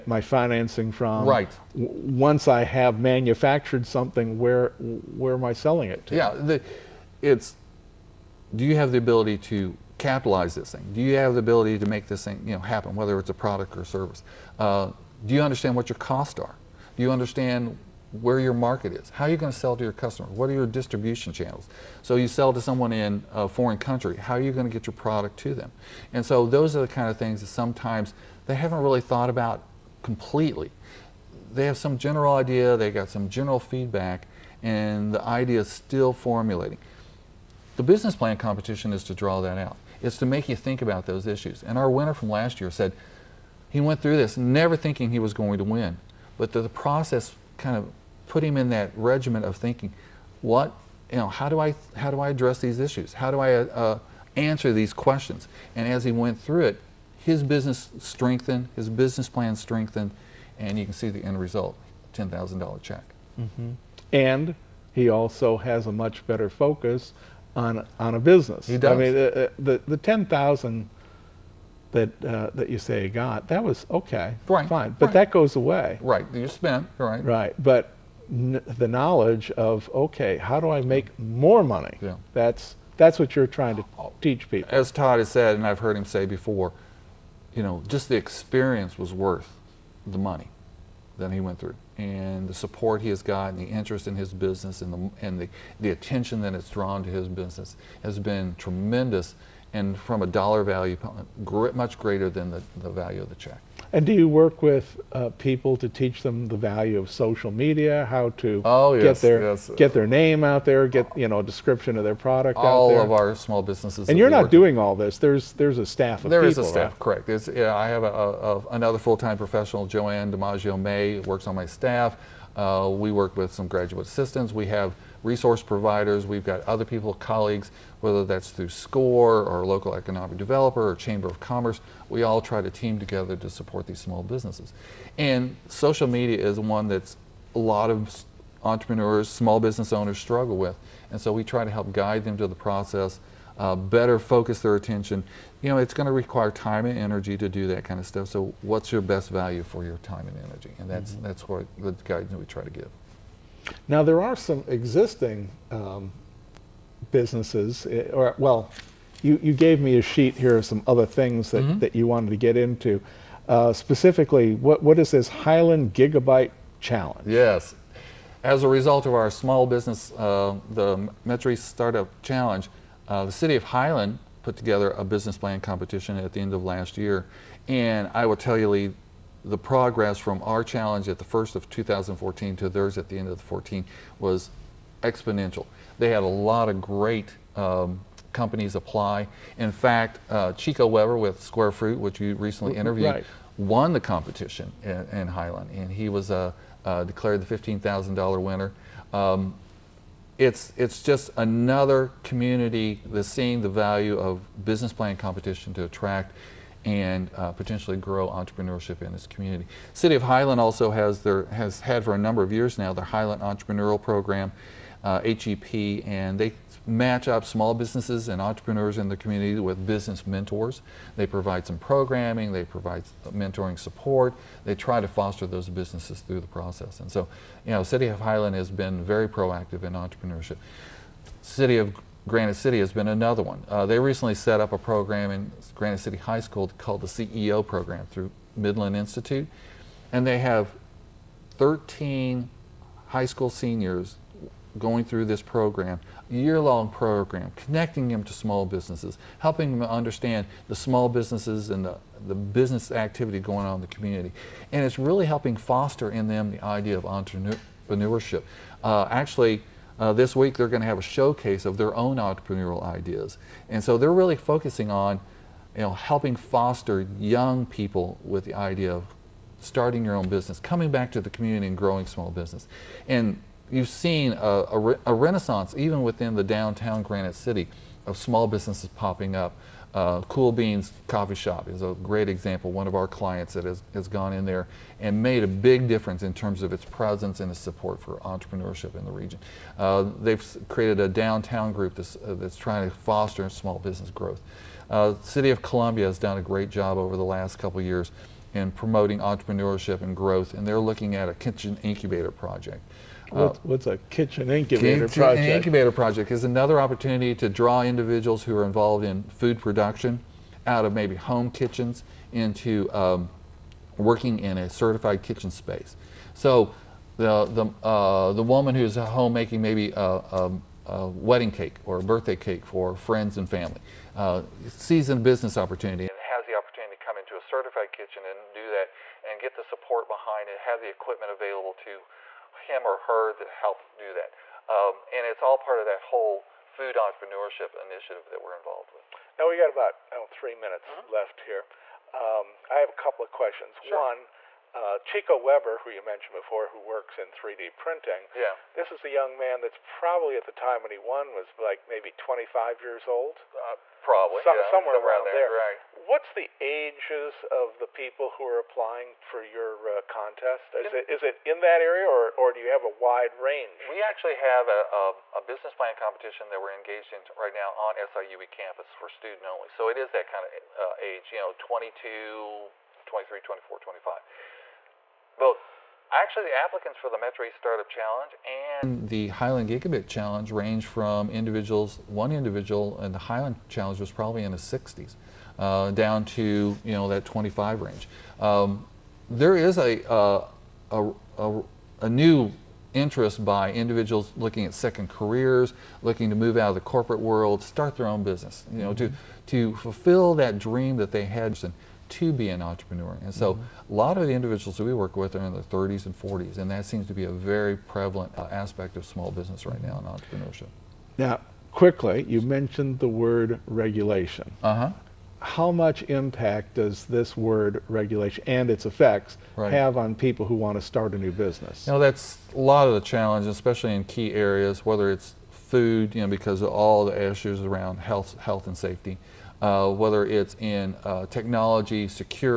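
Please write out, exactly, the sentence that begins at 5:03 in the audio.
What's, uh, what's a kitchen incubator kitchen project?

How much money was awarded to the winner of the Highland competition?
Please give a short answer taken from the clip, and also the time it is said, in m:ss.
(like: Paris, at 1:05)
$15,000, at 3:17.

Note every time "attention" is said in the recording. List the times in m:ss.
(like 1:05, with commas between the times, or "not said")
1:35, 2:24.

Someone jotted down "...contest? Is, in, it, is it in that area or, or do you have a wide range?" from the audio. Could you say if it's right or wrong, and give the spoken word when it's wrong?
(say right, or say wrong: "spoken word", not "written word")
right.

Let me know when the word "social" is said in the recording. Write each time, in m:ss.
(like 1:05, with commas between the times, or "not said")
1:47, 2:15.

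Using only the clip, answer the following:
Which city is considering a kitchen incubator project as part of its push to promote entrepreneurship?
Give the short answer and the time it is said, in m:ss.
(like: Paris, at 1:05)
Columbia, at 4:55.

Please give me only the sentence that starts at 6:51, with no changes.
Now, quickly, you mentioned the word regulation.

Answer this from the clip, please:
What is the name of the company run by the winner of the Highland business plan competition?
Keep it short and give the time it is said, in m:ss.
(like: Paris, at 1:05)
Square Fruit, at 3:11.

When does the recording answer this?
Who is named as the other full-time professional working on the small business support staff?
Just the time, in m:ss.
1:59.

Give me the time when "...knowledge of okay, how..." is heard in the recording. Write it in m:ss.
1:18.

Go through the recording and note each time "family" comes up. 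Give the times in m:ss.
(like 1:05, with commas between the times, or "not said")
5:23.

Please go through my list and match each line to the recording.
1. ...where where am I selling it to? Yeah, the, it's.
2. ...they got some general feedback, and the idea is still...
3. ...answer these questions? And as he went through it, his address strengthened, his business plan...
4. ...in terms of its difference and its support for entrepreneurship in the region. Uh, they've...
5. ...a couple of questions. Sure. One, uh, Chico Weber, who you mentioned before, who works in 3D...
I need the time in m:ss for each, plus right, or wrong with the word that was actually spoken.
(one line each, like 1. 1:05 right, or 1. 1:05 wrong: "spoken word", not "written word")
1. 0:04 right
2. 0:32 right
3. 0:54 wrong: "business", not "address"
4. 4:46 wrong: "presence", not "difference"
5. 5:42 right.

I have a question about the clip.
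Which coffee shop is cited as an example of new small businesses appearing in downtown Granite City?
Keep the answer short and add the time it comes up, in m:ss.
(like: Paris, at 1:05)
Cool Beans, at 4:40.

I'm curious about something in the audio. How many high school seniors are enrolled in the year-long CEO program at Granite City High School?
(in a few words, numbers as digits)
13.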